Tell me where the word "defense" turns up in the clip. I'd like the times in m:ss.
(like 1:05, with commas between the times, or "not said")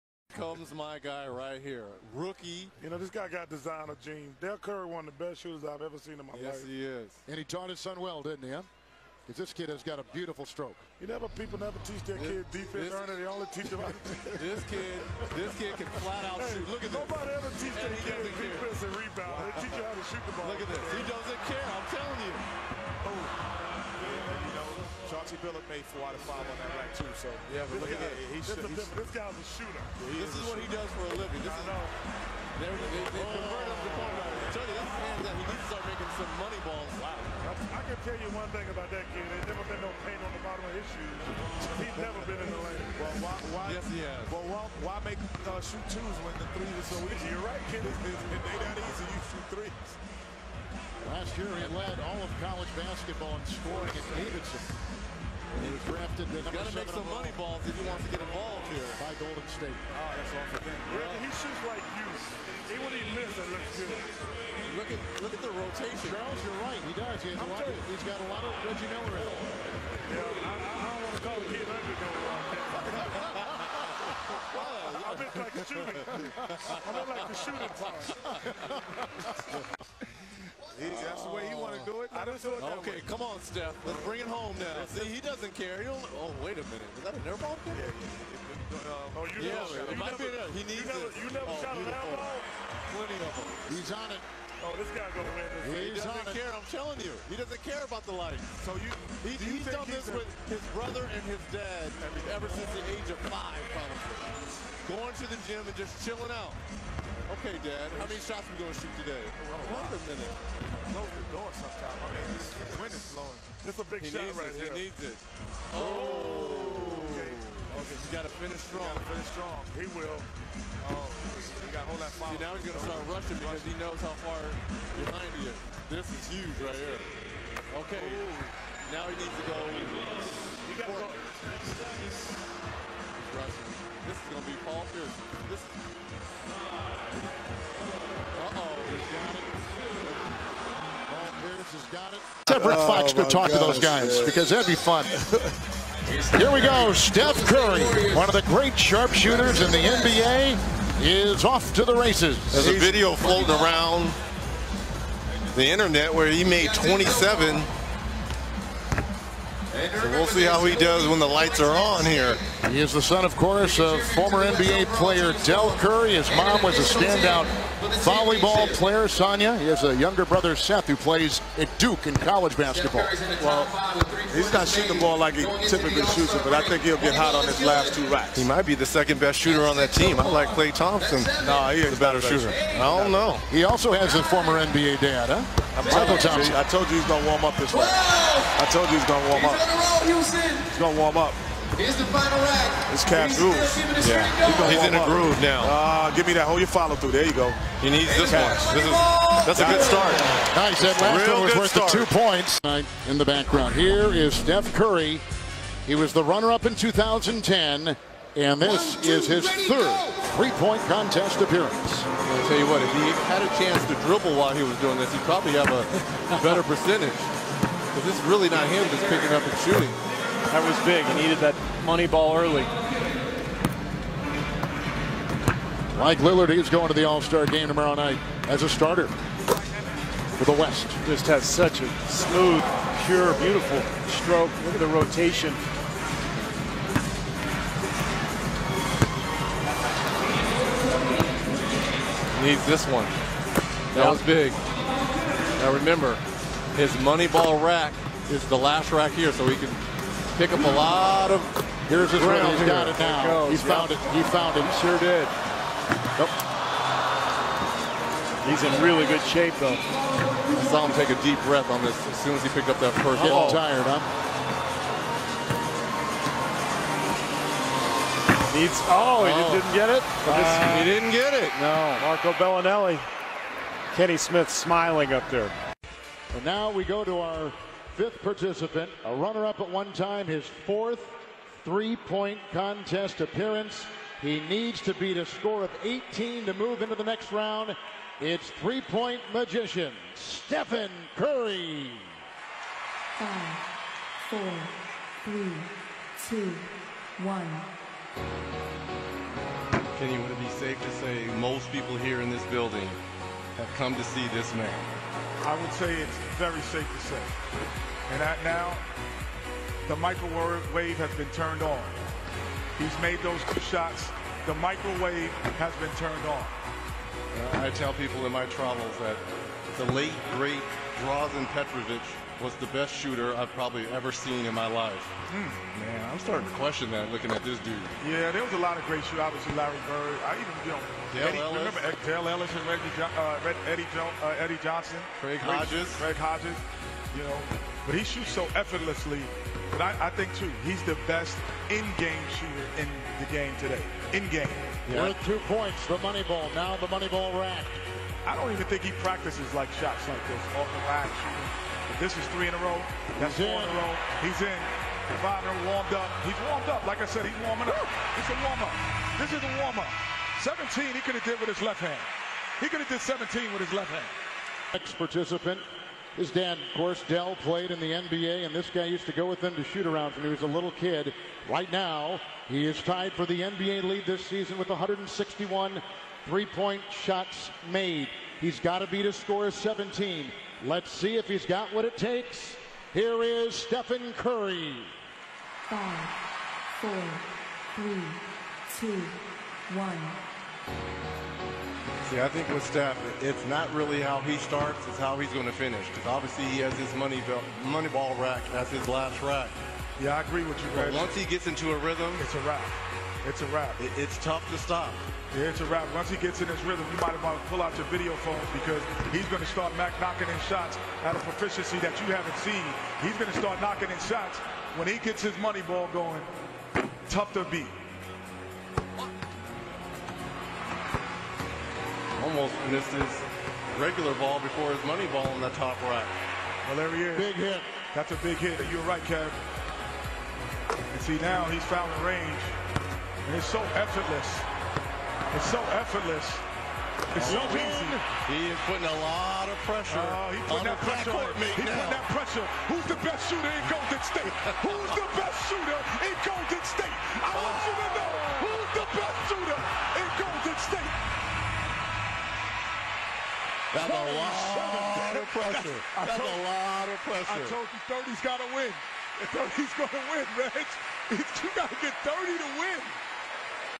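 0:12, 0:18.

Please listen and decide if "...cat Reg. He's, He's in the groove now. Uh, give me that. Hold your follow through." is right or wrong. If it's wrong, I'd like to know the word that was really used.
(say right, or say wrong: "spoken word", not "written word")
wrong: "Yeah", not "Reg".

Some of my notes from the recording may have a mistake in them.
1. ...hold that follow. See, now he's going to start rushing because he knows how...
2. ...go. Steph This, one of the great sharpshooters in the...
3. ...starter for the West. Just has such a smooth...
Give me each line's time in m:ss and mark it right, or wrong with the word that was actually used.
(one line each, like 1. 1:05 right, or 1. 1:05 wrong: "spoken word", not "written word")
1. 2:01 right
2. 2:26 wrong: "Curry", not "This"
3. 3:48 right.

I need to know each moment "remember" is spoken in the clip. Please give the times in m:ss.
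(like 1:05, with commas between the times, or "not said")
4:05, 5:31.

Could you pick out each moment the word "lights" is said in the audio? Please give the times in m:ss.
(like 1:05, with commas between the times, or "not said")
1:38, 2:41.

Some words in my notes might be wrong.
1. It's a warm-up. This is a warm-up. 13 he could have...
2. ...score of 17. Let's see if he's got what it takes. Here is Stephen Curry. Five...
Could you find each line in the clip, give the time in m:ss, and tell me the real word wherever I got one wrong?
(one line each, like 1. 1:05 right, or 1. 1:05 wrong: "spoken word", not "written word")
1. 5:58 wrong: "17", not "13"
2. 6:19 right.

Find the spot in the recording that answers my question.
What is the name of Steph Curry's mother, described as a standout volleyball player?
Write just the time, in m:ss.
2:49.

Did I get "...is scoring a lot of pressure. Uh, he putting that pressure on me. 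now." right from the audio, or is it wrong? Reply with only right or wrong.
wrong.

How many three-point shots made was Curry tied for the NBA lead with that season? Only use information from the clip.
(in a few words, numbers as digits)
161.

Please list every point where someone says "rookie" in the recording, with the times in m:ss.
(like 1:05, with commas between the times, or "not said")
0:02.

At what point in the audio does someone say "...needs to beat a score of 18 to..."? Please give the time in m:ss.
4:44.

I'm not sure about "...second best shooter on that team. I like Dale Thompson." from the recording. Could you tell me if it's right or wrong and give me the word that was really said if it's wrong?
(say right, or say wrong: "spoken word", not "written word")
wrong: "Klay", not "Dale".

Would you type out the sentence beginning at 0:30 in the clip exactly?
Yeah, this is, is what shooter.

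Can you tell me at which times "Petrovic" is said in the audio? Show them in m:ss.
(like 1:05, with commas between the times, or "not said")
5:21.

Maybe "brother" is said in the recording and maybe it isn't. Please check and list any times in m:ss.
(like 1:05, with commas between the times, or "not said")
1:40, 2:50.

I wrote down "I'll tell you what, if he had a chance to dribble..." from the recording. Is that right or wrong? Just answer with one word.
right.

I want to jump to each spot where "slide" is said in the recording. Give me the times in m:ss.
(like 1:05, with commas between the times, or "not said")
not said.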